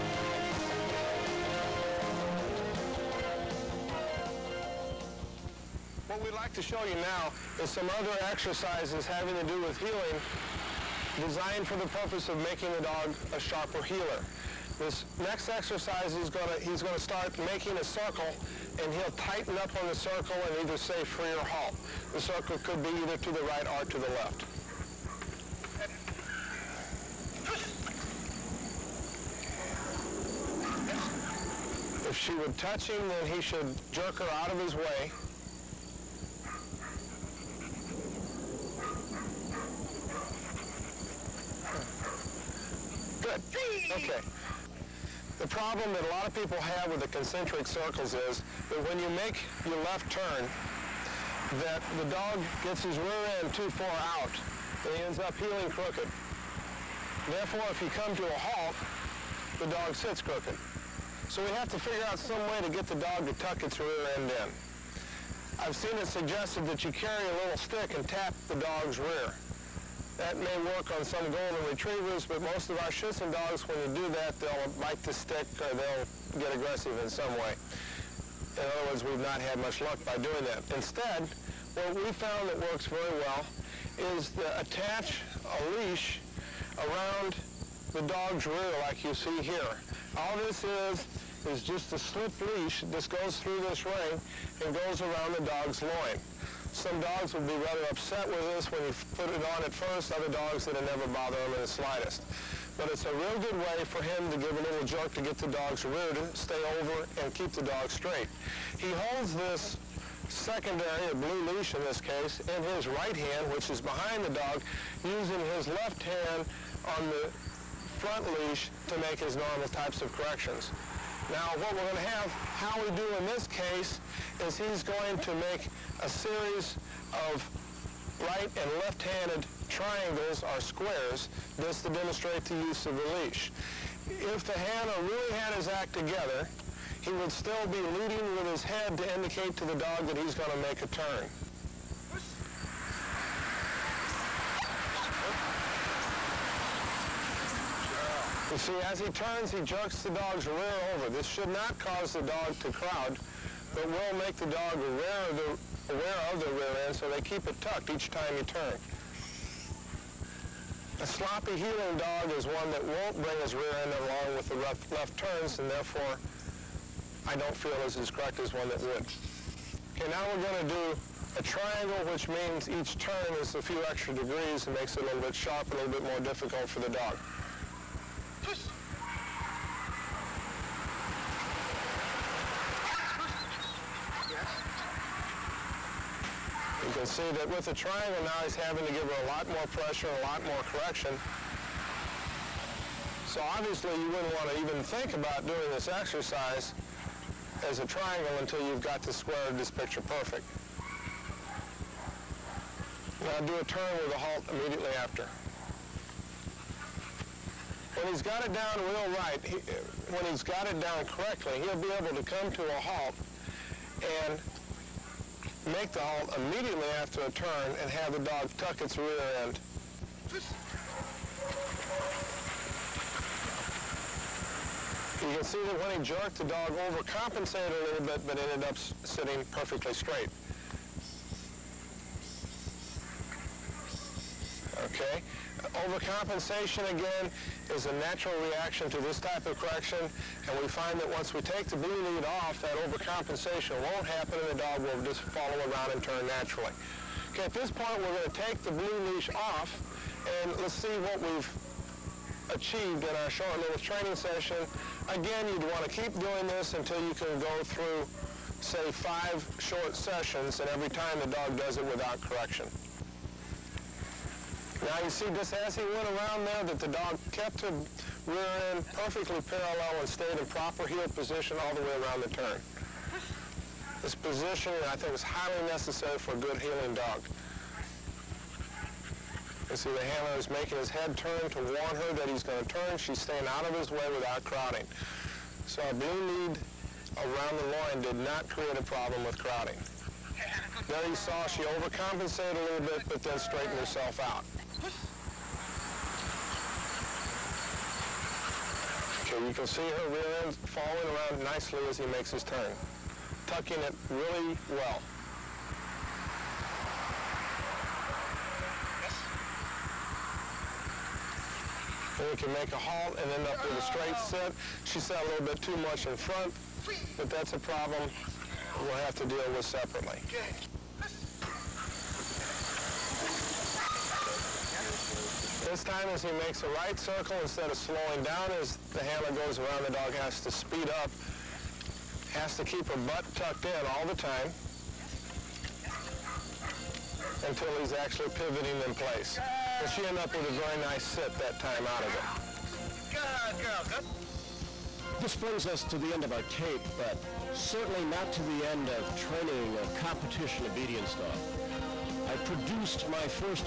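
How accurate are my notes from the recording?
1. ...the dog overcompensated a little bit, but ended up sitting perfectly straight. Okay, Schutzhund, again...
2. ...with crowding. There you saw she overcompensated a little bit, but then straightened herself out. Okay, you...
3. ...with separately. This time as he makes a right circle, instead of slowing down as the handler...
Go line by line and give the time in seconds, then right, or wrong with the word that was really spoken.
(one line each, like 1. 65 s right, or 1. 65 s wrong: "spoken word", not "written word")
1. 226 s wrong: "Overcompensation", not "Schutzhund"
2. 289 s right
3. 319 s right.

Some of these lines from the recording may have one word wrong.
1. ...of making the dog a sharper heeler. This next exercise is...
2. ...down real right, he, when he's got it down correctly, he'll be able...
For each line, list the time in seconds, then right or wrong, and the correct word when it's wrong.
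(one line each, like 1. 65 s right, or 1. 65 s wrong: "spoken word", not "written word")
1. 12 s right
2. 208 s right.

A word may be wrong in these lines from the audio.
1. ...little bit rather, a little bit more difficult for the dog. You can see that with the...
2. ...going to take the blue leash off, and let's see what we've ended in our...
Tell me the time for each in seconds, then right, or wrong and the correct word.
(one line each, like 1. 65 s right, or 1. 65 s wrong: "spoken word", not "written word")
1. 175 s wrong: "sharper", not "rather"
2. 248 s wrong: "achieved", not "ended".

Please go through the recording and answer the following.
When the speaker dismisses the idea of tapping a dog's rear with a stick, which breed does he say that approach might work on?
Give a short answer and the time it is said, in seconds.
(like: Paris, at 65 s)
golden retrievers, at 71 s.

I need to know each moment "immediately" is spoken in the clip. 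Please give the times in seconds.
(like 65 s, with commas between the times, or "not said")
204 s, 216 s.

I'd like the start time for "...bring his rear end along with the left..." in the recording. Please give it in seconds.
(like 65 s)
163 s.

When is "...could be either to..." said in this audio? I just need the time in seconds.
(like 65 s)
22 s.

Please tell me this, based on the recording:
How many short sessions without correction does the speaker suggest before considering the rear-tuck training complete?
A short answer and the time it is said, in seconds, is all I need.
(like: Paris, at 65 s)
5, at 258 s.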